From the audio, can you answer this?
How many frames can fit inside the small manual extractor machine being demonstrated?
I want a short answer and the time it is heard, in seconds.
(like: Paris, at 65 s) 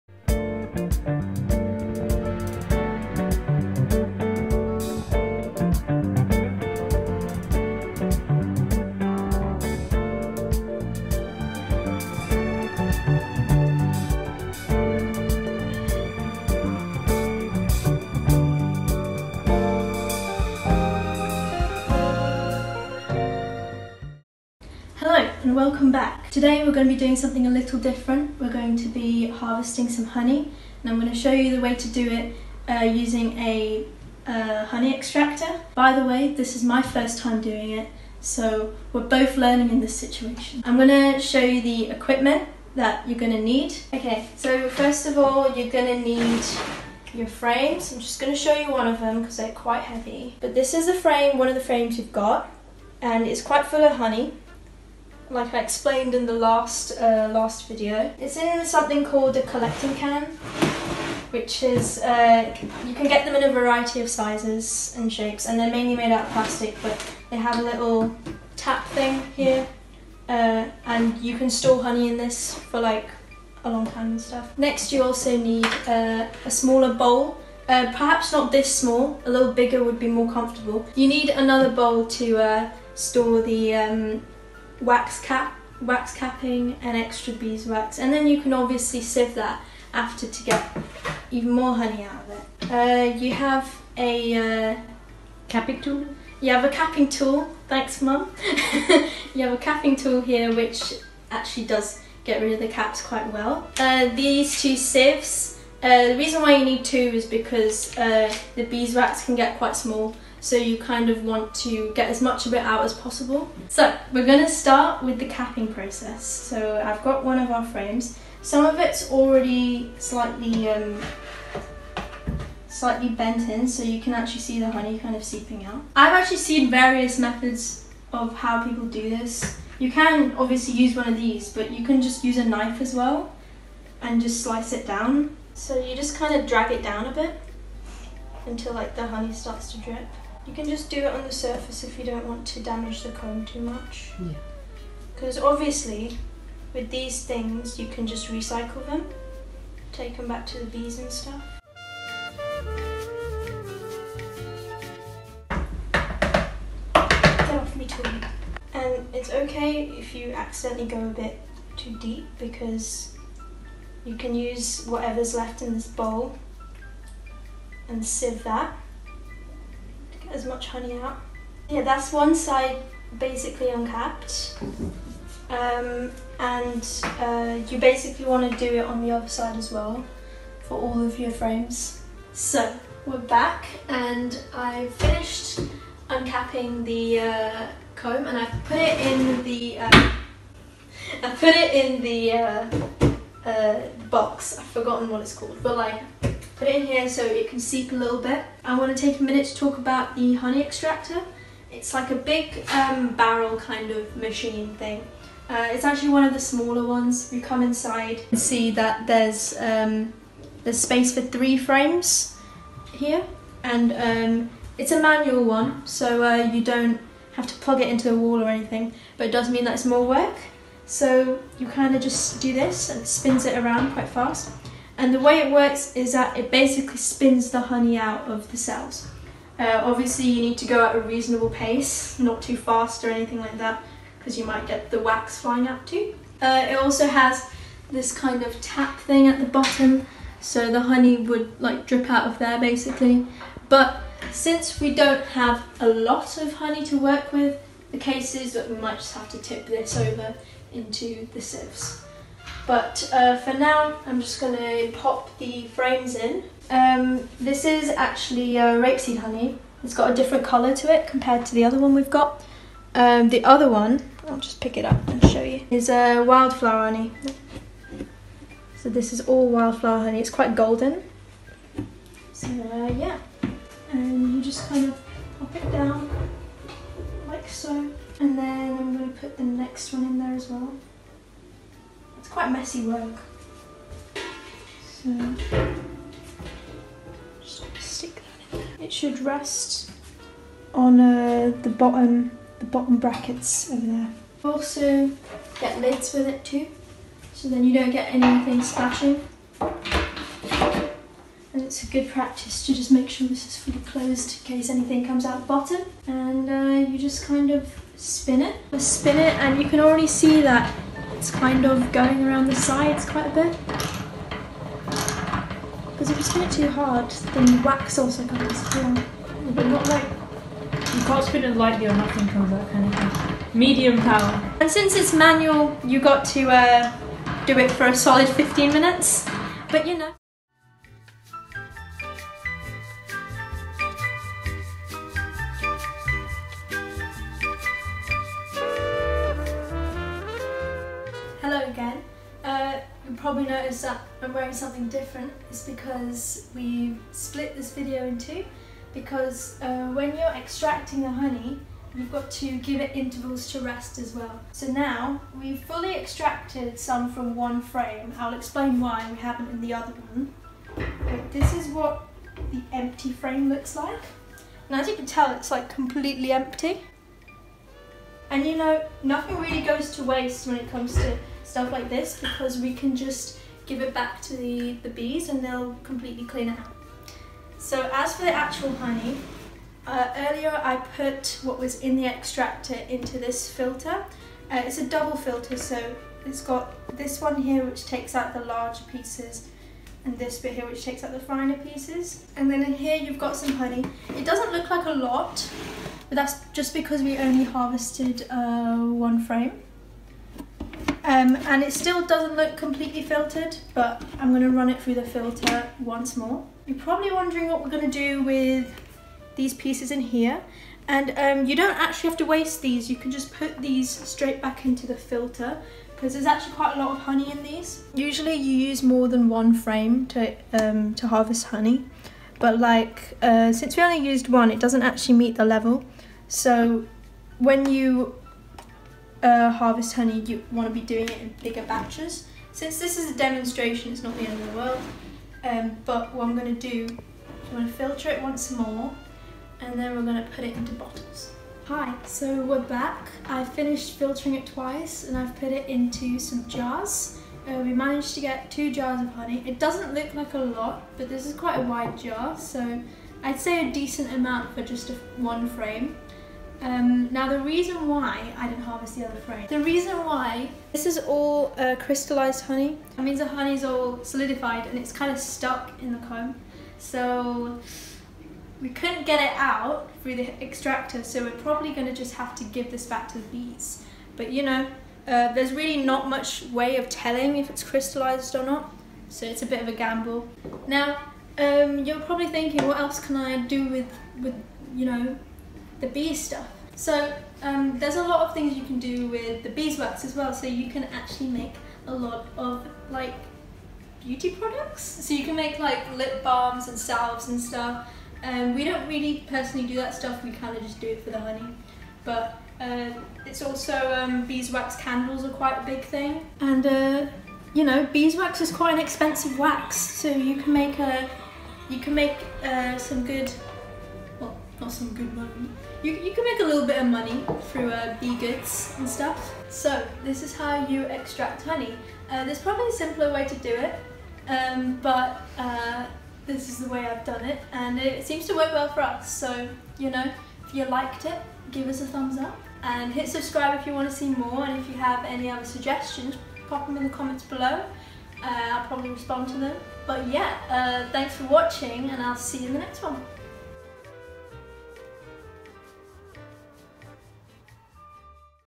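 3, at 211 s.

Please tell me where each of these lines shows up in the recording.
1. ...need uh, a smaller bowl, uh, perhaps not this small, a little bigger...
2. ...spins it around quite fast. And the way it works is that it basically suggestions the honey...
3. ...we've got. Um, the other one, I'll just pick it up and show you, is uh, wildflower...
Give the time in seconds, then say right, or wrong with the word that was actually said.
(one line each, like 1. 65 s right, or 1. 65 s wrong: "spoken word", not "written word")
1. 75 s right
2. 223 s wrong: "spins", not "suggestions"
3. 261 s right.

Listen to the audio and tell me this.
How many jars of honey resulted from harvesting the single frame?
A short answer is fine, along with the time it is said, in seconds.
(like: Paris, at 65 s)
2, at 448 s.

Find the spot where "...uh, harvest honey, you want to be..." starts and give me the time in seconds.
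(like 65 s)
429 s.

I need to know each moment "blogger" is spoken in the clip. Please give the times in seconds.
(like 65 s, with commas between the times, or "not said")
not said.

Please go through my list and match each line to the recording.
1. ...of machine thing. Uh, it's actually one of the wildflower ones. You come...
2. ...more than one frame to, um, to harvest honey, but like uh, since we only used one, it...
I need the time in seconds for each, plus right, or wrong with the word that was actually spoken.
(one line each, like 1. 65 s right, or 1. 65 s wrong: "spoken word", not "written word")
1. 203 s wrong: "smaller", not "wildflower"
2. 418 s right.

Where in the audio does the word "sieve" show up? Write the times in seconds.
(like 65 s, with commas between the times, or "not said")
89 s, 104 s, 168 s, 251 s.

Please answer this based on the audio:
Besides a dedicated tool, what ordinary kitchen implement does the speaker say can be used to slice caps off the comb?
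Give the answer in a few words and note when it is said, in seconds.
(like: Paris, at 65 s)
A knife, at 132 s.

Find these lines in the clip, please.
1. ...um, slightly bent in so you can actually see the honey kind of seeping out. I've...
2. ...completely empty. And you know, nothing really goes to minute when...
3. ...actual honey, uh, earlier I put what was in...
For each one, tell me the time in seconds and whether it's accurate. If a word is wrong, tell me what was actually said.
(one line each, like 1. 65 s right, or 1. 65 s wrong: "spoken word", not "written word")
1. 120 s right
2. 365 s wrong: "waste", not "minute"
3. 378 s right.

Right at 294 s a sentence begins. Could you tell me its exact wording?
Also get lids with it too, so then you don't get anything splashing.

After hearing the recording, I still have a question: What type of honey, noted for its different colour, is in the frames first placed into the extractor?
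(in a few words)
Rapeseed honey.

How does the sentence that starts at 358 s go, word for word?
I'll explain why we haven't in the other one.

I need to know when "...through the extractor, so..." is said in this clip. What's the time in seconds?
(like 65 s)
470 s.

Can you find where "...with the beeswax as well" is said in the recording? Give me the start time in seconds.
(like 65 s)
489 s.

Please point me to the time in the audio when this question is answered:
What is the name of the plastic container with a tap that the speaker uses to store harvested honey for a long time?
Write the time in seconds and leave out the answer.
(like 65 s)
59 s.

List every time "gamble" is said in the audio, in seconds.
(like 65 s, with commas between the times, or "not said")
479 s.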